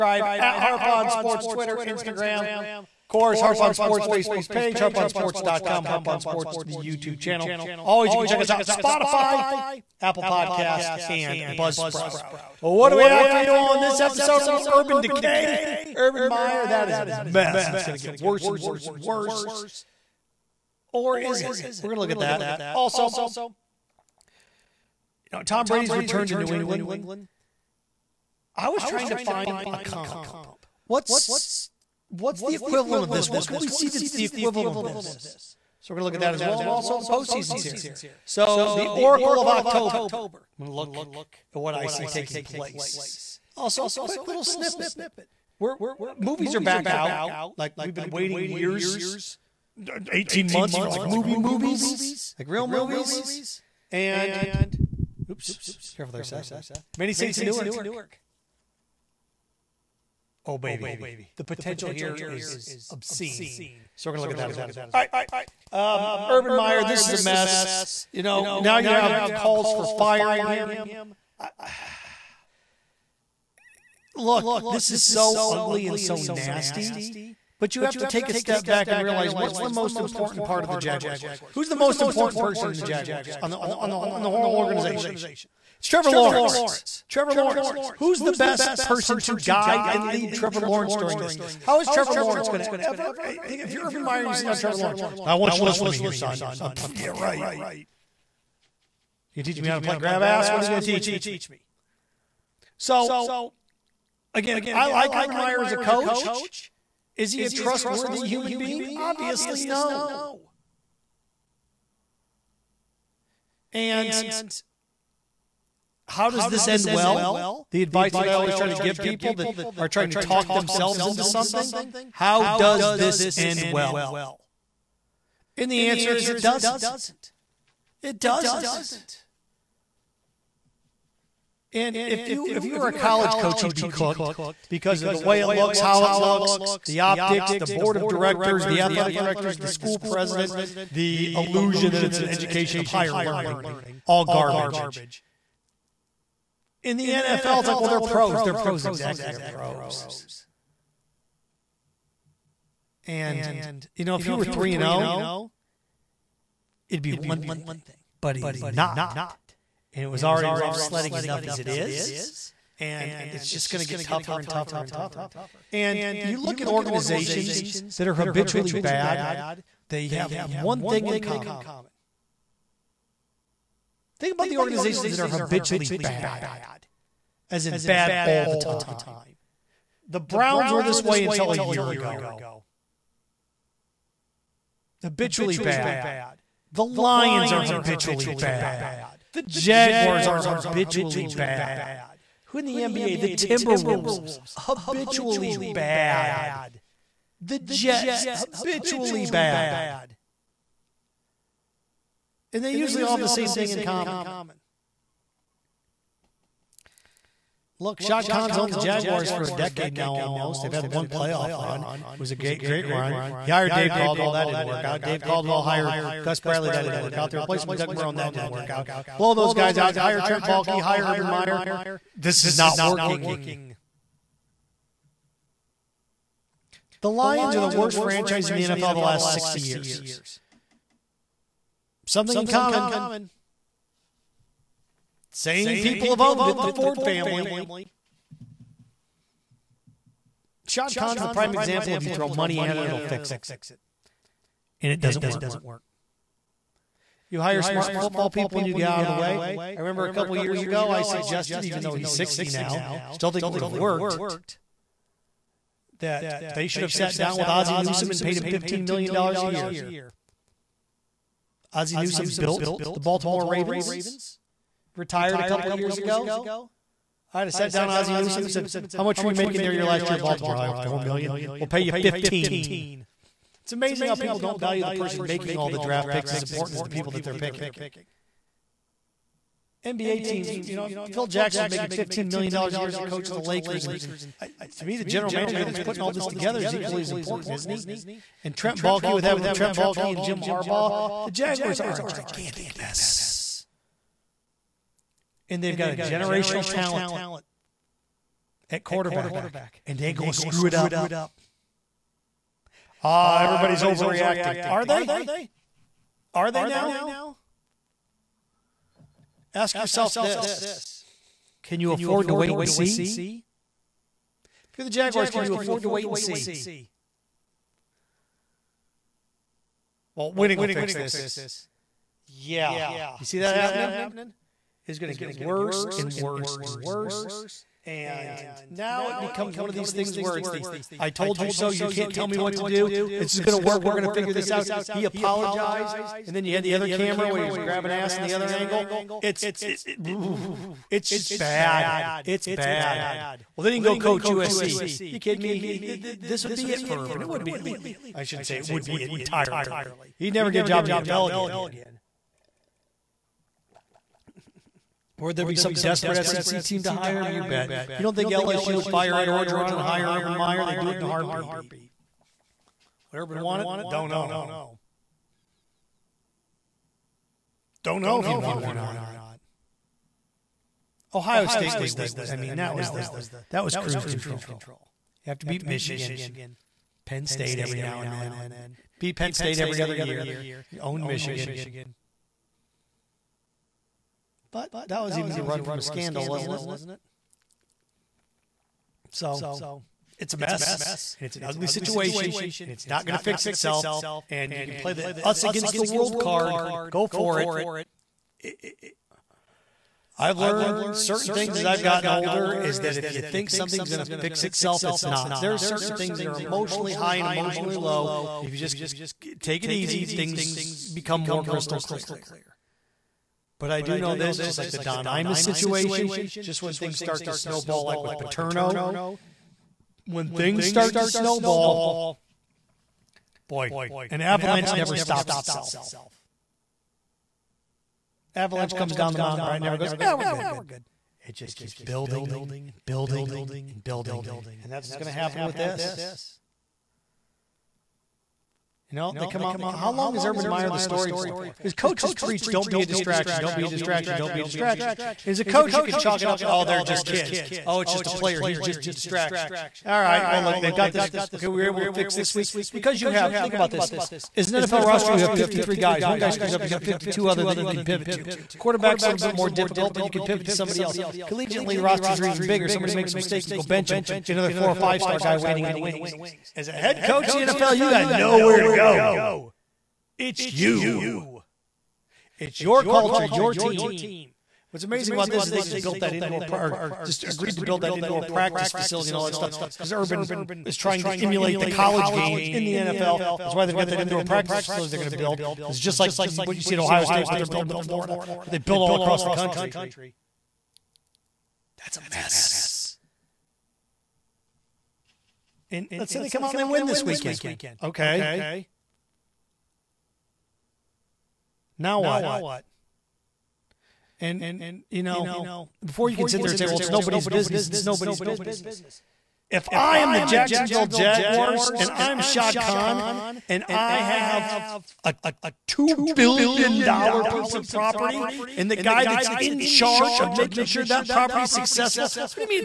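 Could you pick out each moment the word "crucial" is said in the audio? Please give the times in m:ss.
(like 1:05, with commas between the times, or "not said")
not said.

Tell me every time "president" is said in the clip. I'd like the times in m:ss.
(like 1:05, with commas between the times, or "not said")
2:19.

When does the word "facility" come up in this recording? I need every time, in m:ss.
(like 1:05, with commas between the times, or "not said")
7:58, 8:04.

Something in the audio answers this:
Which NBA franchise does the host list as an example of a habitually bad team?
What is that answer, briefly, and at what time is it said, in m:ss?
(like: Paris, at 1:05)
Timberwolves, at 3:13.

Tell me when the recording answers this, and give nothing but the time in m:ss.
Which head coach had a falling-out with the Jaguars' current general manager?
4:50.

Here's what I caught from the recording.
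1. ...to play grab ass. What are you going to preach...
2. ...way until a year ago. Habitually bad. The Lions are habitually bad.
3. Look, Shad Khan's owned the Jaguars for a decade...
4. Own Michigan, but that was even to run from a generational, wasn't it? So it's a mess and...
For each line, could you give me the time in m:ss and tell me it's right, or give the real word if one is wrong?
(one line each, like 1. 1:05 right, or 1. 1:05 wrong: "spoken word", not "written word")
1. 1:39 wrong: "teach", not "preach"
2. 3:01 right
3. 3:27 right
4. 6:20 wrong: "scandal", not "generational".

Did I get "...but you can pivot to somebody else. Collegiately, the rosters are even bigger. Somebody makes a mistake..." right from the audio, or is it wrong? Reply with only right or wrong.
right.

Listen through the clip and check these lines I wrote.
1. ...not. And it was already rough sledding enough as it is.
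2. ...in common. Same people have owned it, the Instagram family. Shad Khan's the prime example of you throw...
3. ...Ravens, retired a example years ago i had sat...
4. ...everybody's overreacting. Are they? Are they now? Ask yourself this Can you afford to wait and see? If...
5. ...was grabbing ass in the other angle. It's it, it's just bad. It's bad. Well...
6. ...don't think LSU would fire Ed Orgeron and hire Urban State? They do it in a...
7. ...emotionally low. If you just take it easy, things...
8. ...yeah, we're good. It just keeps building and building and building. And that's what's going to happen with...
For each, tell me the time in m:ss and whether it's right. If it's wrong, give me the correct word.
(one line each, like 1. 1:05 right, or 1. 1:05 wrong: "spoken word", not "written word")
1. 2:38 right
2. 3:52 wrong: "Ford", not "Instagram"
3. 4:23 wrong: "couple", not "example"
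4. 5:03 right
5. 5:37 right
6. 5:58 wrong: "Meyer", not "State"
7. 6:47 right
8. 7:10 right.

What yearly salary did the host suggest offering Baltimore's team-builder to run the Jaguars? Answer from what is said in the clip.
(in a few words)
$15 million.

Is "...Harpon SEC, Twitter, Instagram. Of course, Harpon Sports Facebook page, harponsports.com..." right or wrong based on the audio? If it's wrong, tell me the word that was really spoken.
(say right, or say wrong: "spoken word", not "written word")
wrong: "Sports", not "SEC".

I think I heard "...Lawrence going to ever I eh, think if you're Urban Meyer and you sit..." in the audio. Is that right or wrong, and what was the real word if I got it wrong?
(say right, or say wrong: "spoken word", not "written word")
right.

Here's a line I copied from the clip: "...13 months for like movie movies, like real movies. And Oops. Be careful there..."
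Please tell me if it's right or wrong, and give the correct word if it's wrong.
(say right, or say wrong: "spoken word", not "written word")
wrong: "18", not "13".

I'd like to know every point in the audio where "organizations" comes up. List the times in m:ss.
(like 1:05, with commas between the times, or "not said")
1:24, 2:46, 2:54.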